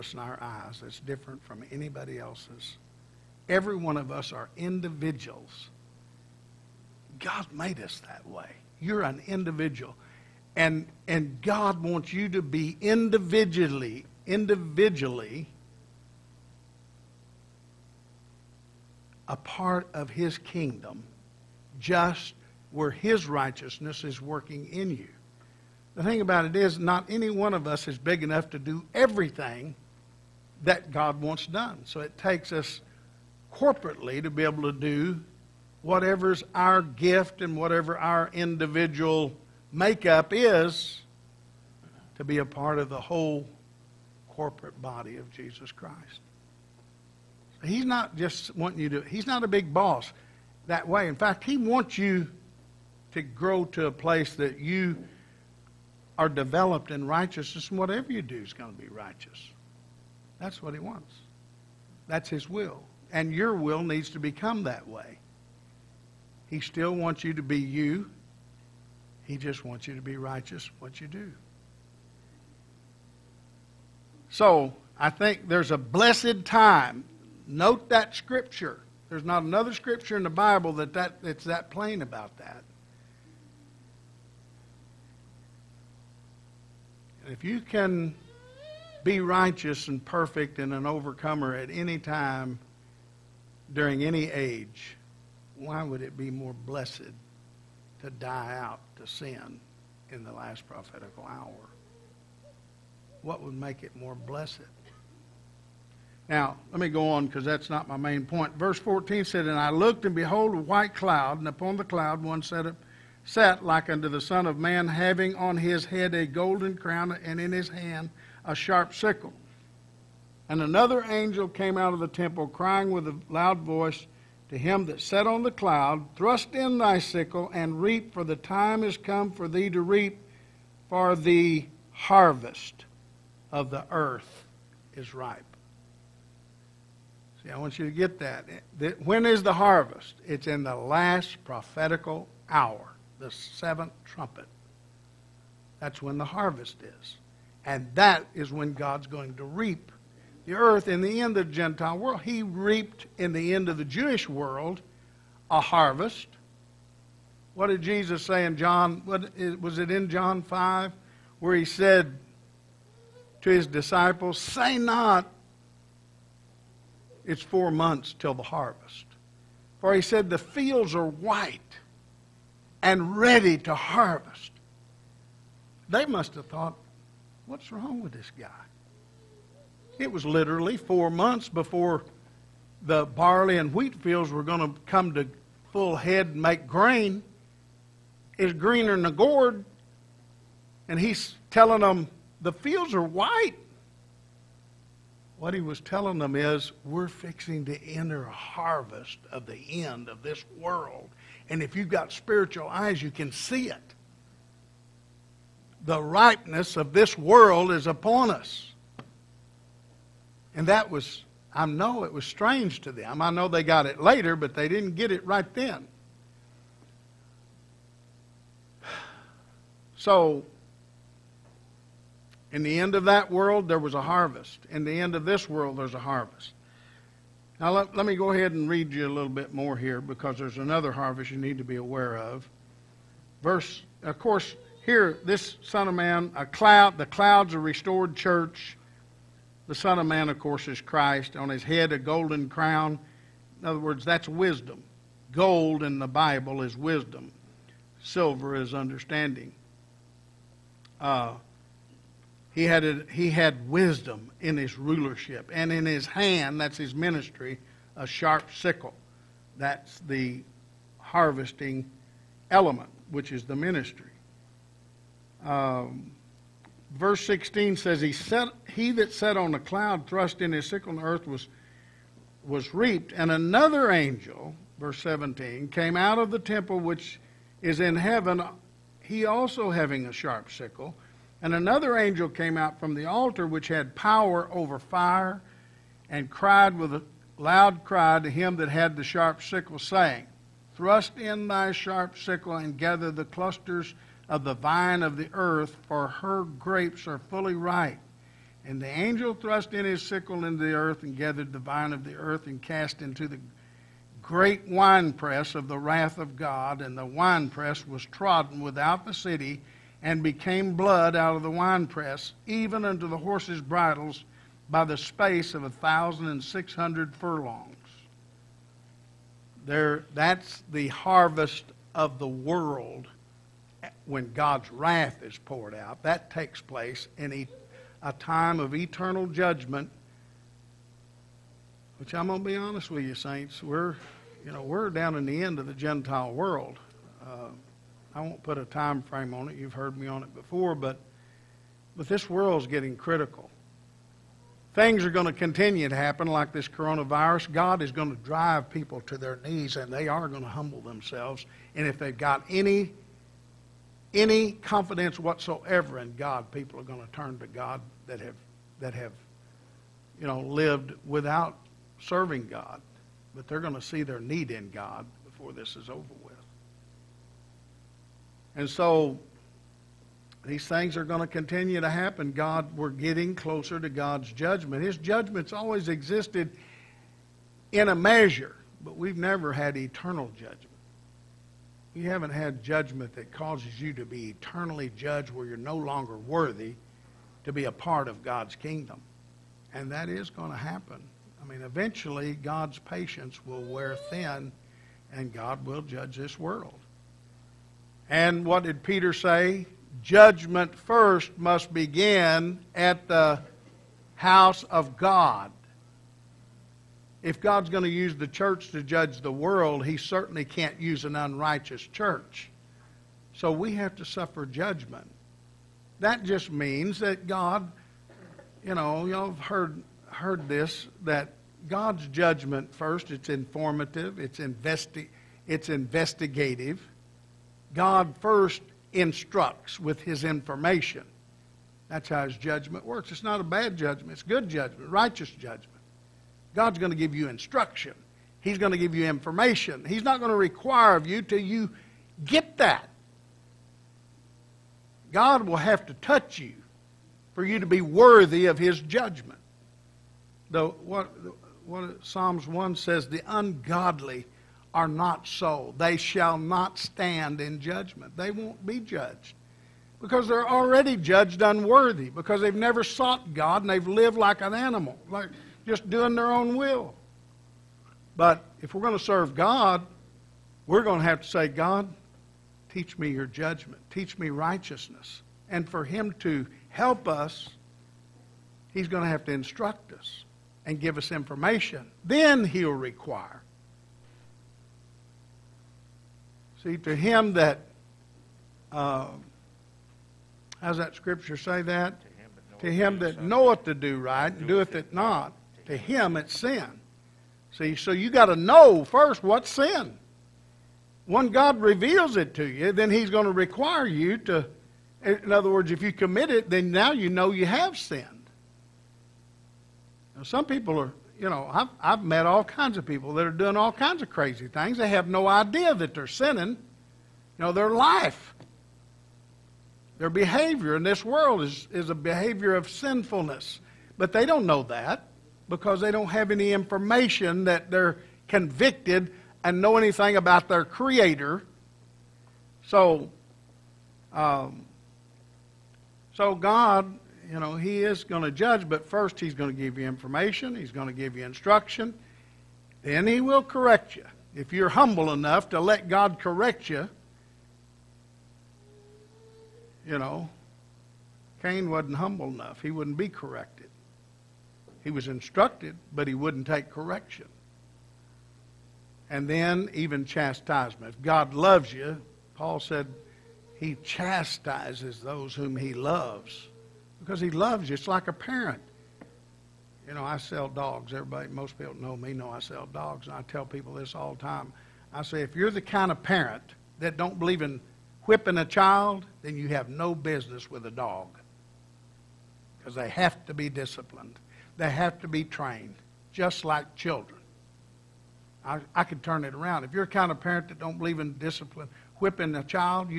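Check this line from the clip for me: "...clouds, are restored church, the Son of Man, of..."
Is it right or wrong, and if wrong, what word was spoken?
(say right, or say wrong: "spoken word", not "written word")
right.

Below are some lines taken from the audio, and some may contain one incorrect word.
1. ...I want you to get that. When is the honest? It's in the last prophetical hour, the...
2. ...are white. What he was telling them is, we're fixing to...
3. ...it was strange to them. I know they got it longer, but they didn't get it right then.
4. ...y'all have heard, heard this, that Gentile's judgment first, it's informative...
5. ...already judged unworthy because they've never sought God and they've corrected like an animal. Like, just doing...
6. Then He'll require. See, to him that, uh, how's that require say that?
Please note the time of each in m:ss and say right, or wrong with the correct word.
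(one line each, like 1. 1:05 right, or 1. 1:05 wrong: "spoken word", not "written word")
1. 2:17 wrong: "harvest", not "honest"
2. 3:12 right
3. 3:32 wrong: "later", not "longer"
4. 6:59 wrong: "God", not "Gentile"
5. 7:40 wrong: "lived", not "corrected"
6. 8:02 wrong: "scripture", not "require".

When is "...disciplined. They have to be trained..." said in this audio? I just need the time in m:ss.
9:43.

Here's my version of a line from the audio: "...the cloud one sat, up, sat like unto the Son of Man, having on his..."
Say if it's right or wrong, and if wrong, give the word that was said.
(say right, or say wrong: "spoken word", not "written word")
right.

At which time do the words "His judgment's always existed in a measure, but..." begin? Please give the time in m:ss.
6:14.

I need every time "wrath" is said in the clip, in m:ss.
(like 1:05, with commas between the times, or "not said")
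5:05, 5:24.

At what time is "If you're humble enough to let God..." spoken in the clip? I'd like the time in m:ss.
9:04.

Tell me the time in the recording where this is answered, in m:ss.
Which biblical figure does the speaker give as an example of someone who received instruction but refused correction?
9:11.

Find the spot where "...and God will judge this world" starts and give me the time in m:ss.
6:35.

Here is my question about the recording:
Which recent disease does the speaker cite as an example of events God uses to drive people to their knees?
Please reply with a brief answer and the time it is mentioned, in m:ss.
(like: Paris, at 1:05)
Coronavirus, at 5:46.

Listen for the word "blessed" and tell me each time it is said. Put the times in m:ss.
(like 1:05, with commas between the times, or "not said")
1:15, 1:36, 1:44.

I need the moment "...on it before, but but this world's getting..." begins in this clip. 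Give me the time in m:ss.
5:40.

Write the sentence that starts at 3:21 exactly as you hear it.
And if you've got spiritual eyes, you can see it.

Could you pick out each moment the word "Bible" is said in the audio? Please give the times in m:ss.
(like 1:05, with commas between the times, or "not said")
1:20, 4:06.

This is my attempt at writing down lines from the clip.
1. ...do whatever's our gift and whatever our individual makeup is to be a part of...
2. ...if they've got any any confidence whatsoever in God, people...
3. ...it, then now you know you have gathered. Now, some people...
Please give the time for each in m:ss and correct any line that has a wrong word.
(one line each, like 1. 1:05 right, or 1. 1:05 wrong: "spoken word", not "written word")
1. 0:34 right
2. 5:51 right
3. 8:26 wrong: "sinned", not "gathered".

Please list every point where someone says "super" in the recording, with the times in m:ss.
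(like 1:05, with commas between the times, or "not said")
not said.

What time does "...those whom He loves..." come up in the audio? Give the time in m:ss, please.
9:25.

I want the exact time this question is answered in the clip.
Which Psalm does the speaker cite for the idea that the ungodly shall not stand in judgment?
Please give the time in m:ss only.
7:32.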